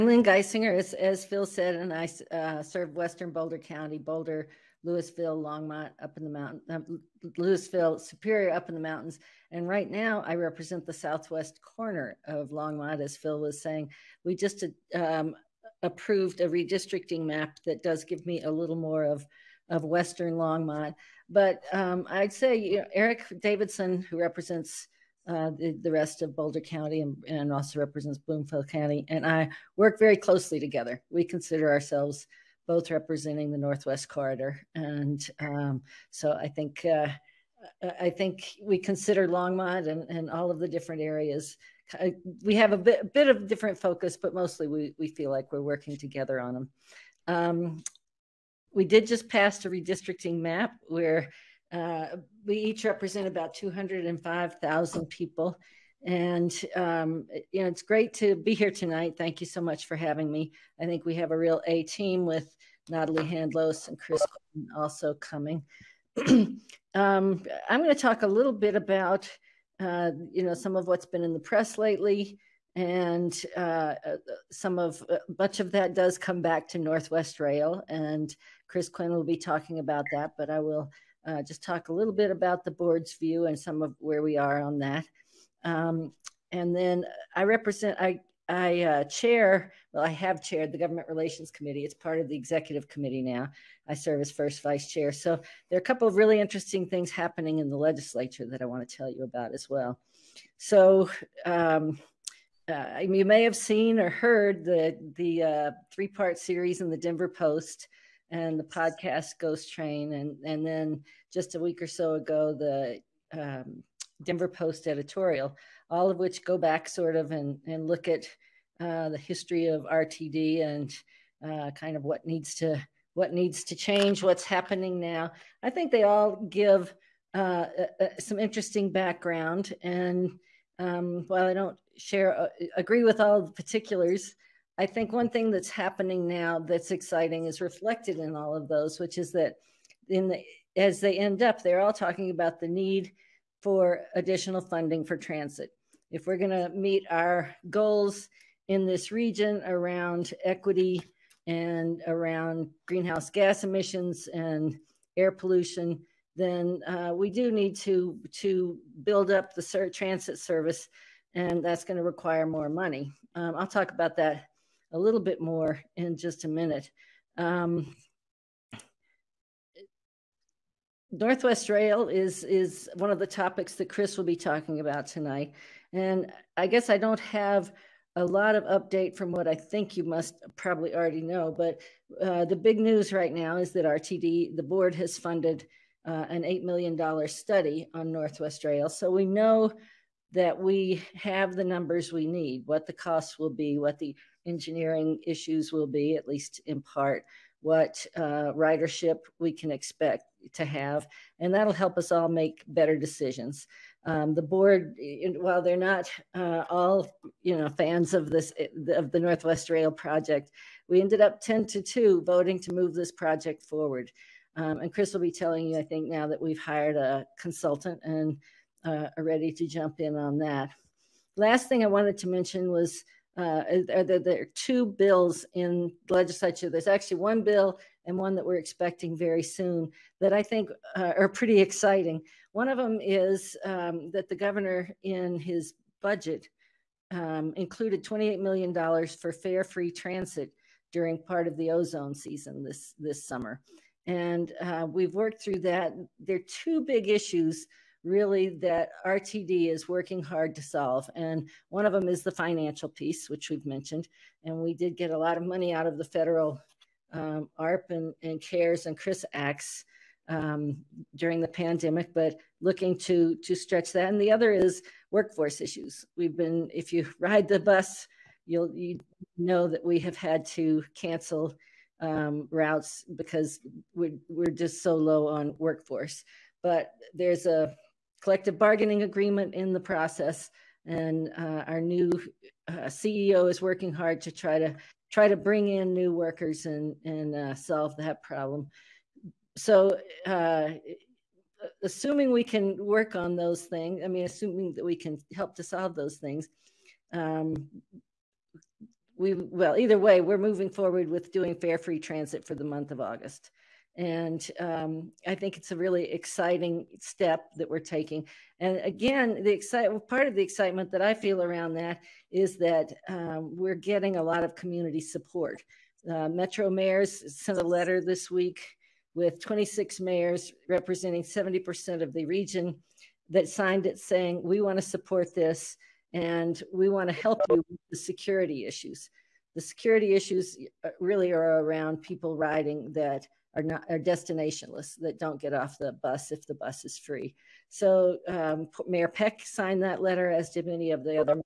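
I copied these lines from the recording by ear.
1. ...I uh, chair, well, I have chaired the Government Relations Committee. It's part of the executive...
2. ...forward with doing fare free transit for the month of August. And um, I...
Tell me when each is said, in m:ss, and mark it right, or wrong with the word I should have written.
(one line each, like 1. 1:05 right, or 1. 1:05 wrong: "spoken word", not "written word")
1. 1:28 right
2. 5:00 right.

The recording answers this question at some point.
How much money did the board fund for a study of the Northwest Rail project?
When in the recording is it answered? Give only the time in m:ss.
3:06.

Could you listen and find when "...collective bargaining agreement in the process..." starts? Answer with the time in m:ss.
4:38.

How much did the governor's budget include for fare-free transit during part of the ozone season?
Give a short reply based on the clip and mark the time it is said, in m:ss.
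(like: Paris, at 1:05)
$28 million, at 3:58.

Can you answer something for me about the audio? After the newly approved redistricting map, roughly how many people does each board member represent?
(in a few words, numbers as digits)
205,000.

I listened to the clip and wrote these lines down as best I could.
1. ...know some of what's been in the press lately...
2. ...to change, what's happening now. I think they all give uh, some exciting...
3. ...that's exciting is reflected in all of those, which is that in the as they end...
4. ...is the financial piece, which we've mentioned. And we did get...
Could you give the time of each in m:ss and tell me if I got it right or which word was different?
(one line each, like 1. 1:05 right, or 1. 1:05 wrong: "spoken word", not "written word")
1. 1:10 right
2. 2:03 wrong: "interesting", not "exciting"
3. 2:16 right
4. 4:12 right.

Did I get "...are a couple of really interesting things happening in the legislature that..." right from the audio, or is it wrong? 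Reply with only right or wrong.
right.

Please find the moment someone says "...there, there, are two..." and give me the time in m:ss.
3:43.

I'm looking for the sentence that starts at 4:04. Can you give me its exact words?
And uh, we've worked through that.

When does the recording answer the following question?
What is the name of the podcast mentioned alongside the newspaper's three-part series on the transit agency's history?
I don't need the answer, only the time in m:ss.
1:49.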